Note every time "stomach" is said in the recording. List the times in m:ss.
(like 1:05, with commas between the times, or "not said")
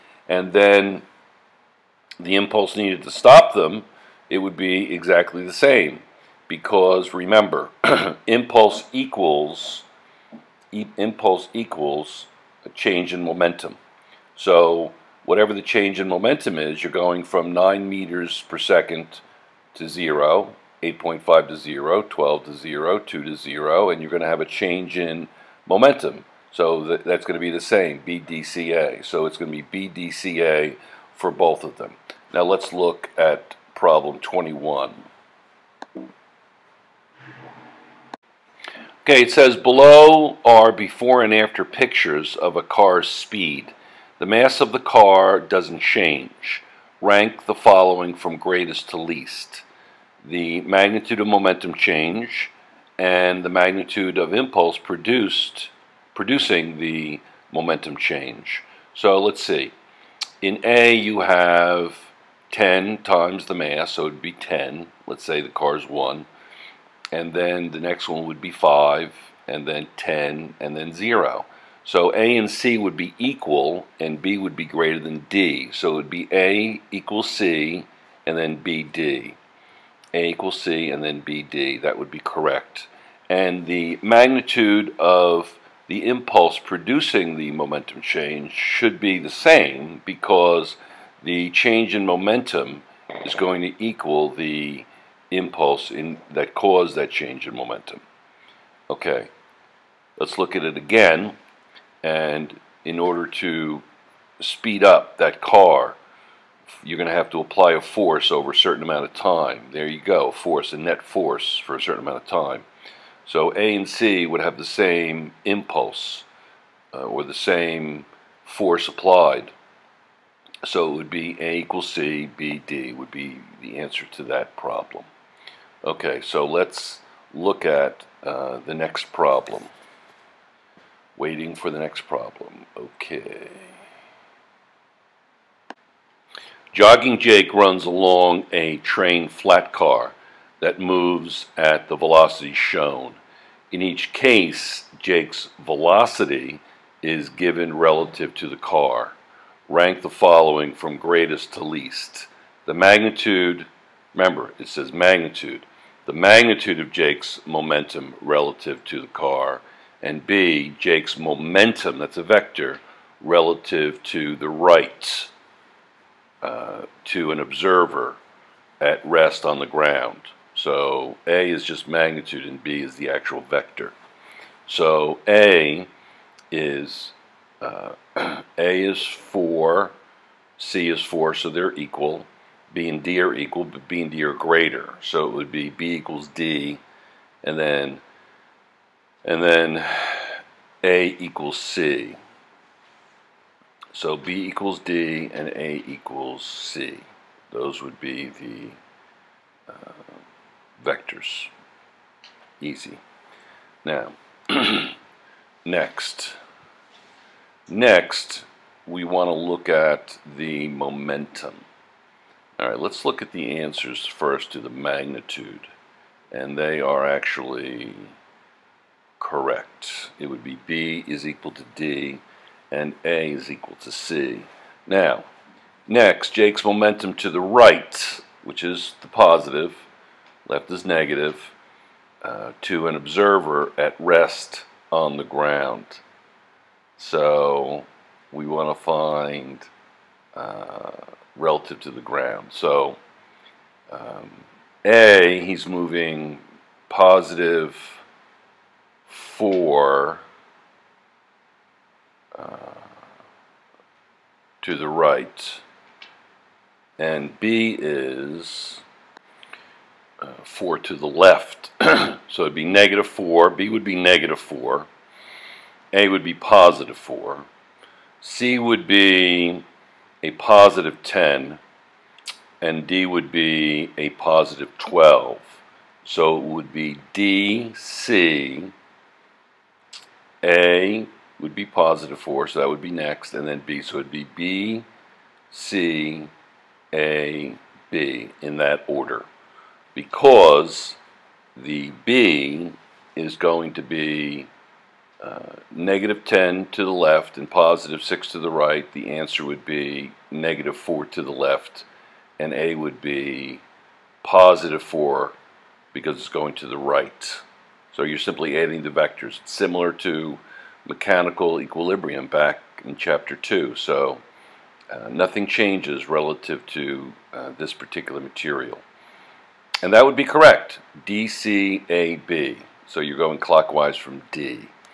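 not said.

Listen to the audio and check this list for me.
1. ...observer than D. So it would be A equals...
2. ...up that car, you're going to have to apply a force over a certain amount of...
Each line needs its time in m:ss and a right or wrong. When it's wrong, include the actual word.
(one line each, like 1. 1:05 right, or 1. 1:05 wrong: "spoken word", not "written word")
1. 1:14 wrong: "greater", not "observer"
2. 1:44 right.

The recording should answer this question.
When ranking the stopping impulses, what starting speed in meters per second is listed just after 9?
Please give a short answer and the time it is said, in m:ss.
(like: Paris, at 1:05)
8.5, at 0:20.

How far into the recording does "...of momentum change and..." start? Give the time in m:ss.
0:51.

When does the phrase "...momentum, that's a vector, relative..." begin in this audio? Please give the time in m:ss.
2:41.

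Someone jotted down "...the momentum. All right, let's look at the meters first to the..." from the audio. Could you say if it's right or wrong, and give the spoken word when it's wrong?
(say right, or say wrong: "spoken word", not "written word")
wrong: "answers", not "meters".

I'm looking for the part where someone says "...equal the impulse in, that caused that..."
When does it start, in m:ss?
1:33.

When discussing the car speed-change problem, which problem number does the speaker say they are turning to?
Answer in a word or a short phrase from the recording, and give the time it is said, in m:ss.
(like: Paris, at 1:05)
21, at 0:33.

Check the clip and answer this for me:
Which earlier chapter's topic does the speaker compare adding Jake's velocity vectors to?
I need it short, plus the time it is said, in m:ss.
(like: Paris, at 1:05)
2, at 5:12.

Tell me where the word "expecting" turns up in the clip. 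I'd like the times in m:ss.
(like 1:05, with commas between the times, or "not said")
not said.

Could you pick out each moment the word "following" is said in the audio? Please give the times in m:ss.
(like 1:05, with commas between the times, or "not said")
0:47, 2:30.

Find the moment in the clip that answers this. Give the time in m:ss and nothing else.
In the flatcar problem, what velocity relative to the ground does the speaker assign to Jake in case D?
4:33.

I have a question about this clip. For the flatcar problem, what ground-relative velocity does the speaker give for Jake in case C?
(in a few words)
positive 10.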